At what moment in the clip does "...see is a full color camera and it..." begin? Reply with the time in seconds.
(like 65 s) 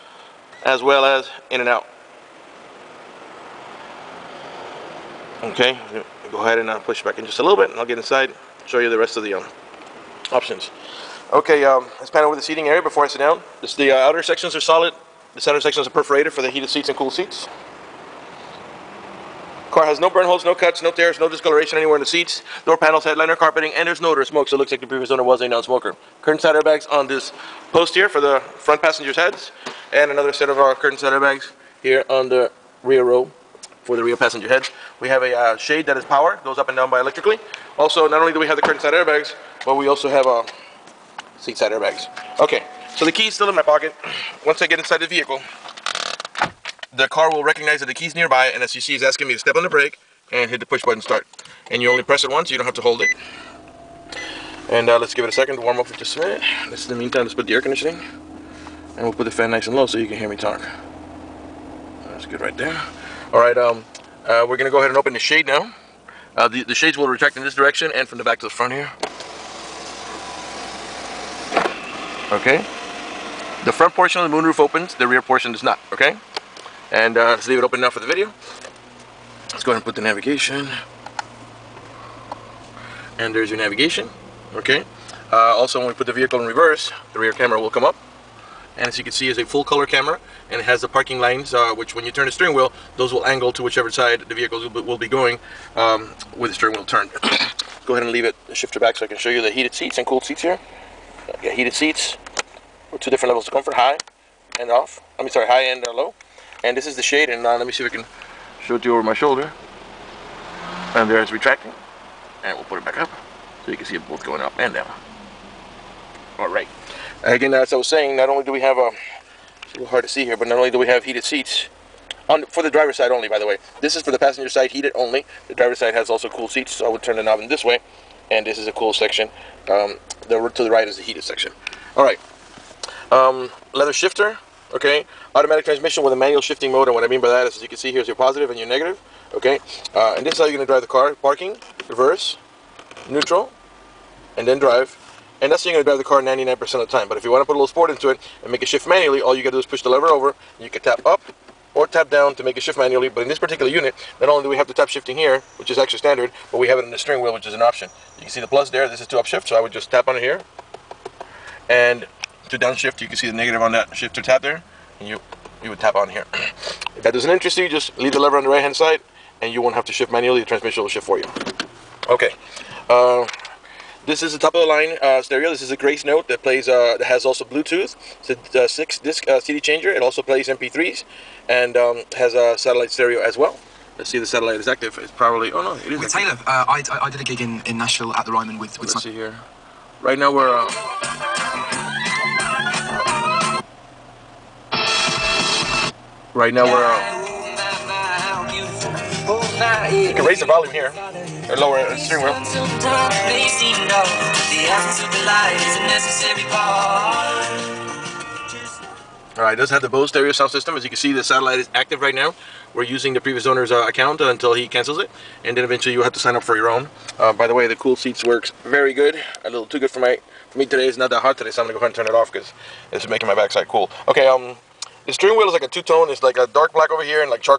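89 s.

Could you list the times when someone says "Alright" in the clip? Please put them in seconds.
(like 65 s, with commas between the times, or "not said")
209 s.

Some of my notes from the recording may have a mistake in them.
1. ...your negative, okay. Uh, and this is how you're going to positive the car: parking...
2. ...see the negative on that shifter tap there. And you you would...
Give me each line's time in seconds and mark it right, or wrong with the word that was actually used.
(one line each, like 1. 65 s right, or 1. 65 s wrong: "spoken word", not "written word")
1. 138 s wrong: "drive", not "positive"
2. 163 s right.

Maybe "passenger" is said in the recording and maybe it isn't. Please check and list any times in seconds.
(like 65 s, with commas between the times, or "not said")
28 s, 34 s, 124 s.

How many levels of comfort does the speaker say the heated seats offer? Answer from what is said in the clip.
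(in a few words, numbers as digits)
2.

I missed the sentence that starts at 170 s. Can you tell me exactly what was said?
The transmission will shift for you.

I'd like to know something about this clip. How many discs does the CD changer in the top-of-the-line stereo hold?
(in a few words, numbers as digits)
6.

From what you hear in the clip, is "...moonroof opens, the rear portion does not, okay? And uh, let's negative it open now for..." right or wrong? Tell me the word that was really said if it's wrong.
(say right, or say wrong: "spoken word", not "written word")
wrong: "leave", not "negative".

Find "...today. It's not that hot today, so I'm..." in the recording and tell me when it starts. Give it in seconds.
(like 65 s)
220 s.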